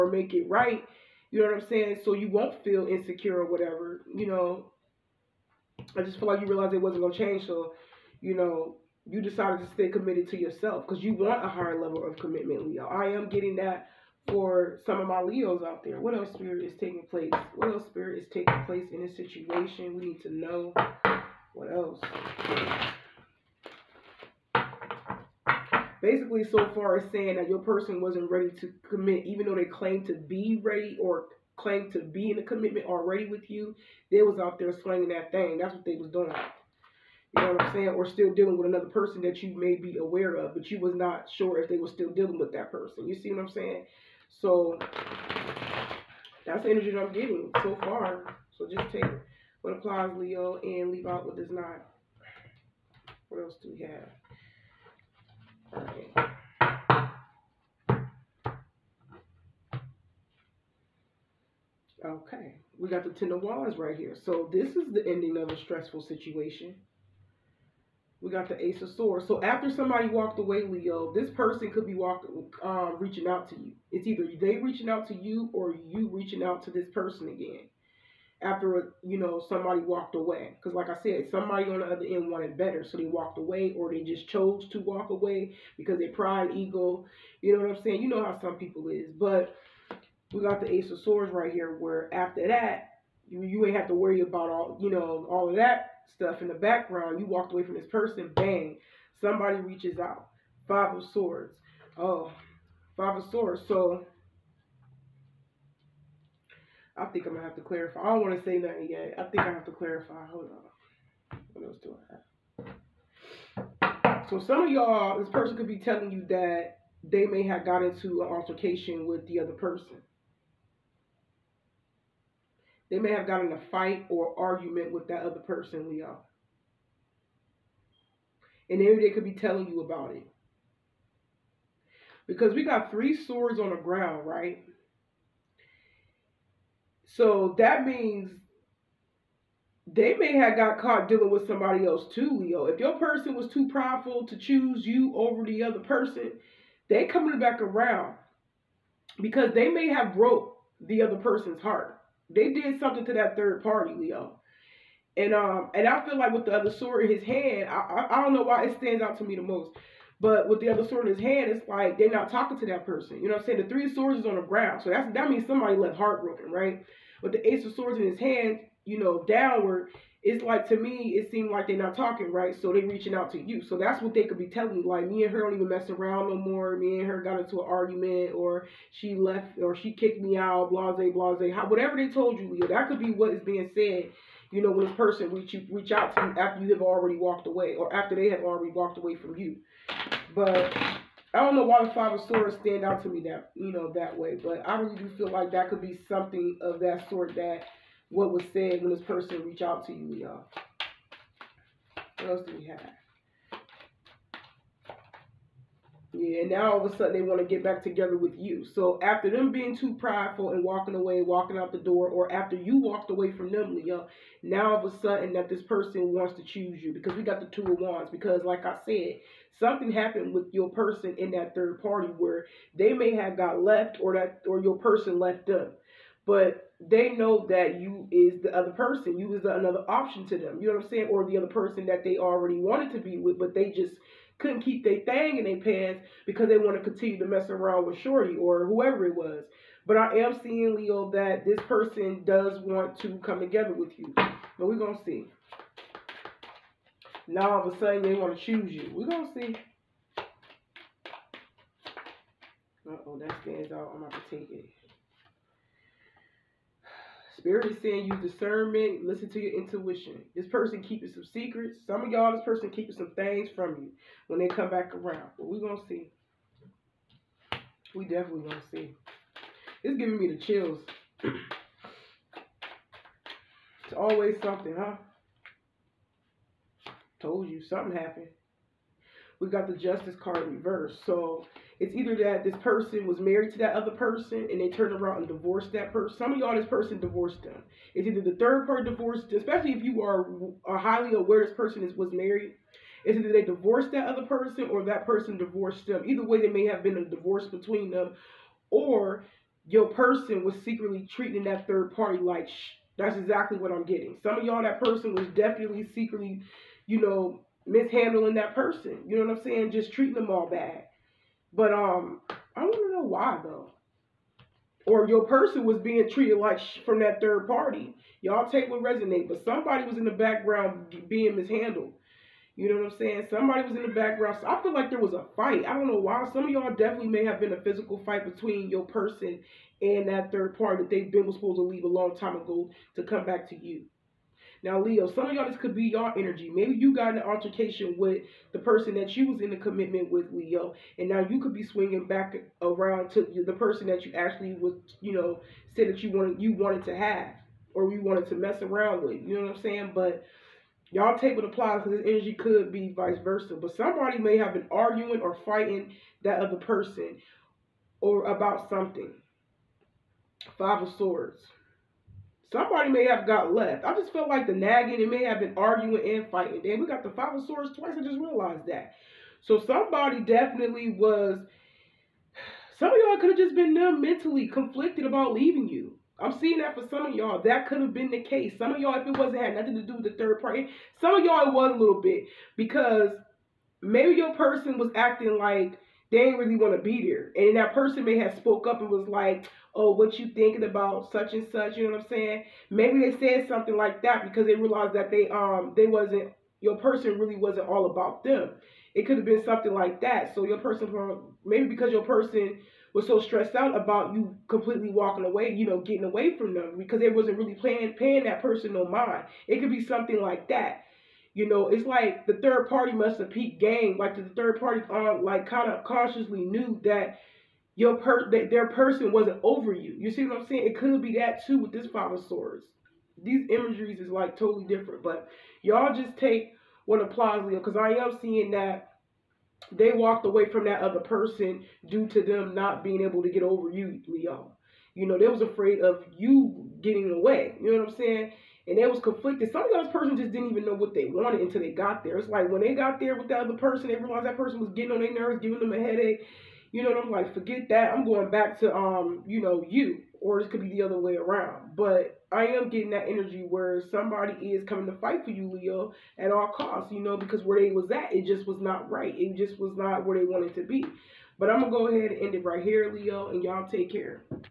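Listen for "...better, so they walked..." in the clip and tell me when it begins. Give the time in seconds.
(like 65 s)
82 s.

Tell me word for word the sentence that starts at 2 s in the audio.
So you won't feel insecure or whatever.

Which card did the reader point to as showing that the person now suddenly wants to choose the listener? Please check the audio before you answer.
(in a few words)
Two of Wands.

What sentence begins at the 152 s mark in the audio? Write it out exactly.
They did something to that third party, Leo.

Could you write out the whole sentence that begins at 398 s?
It could have been something like that.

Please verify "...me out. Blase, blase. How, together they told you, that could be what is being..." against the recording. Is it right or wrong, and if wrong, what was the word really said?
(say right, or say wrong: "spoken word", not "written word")
wrong: "whatever", not "together".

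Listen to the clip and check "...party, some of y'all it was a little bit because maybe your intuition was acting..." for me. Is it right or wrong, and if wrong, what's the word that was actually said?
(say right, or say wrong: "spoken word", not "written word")
wrong: "person", not "intuition".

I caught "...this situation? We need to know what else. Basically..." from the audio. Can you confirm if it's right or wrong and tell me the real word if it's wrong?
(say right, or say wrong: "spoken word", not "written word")
right.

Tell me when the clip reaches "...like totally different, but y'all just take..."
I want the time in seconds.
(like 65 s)
424 s.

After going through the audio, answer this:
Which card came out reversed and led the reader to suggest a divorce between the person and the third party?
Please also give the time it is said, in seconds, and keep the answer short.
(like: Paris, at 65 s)
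Justice, at 279 s.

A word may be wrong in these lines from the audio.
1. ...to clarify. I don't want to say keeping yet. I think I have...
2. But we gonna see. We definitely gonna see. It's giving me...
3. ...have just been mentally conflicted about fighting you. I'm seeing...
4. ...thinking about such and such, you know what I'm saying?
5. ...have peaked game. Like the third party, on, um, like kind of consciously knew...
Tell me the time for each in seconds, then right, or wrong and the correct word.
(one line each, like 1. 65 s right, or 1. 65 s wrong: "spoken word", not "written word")
1. 107 s wrong: "nothing", not "keeping"
2. 265 s right
3. 373 s wrong: "leaving", not "fighting"
4. 390 s right
5. 413 s right.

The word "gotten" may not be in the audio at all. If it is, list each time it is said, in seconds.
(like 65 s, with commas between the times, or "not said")
123 s.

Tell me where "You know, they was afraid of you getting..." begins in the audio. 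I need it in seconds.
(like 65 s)
434 s.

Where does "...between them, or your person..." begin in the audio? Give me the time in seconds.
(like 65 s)
297 s.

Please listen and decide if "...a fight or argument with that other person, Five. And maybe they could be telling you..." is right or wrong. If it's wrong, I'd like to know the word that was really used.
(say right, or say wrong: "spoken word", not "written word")
wrong: "Leo", not "Five".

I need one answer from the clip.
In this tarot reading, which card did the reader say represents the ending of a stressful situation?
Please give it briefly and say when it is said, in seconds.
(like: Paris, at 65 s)
Ten of Wands, at 63 s.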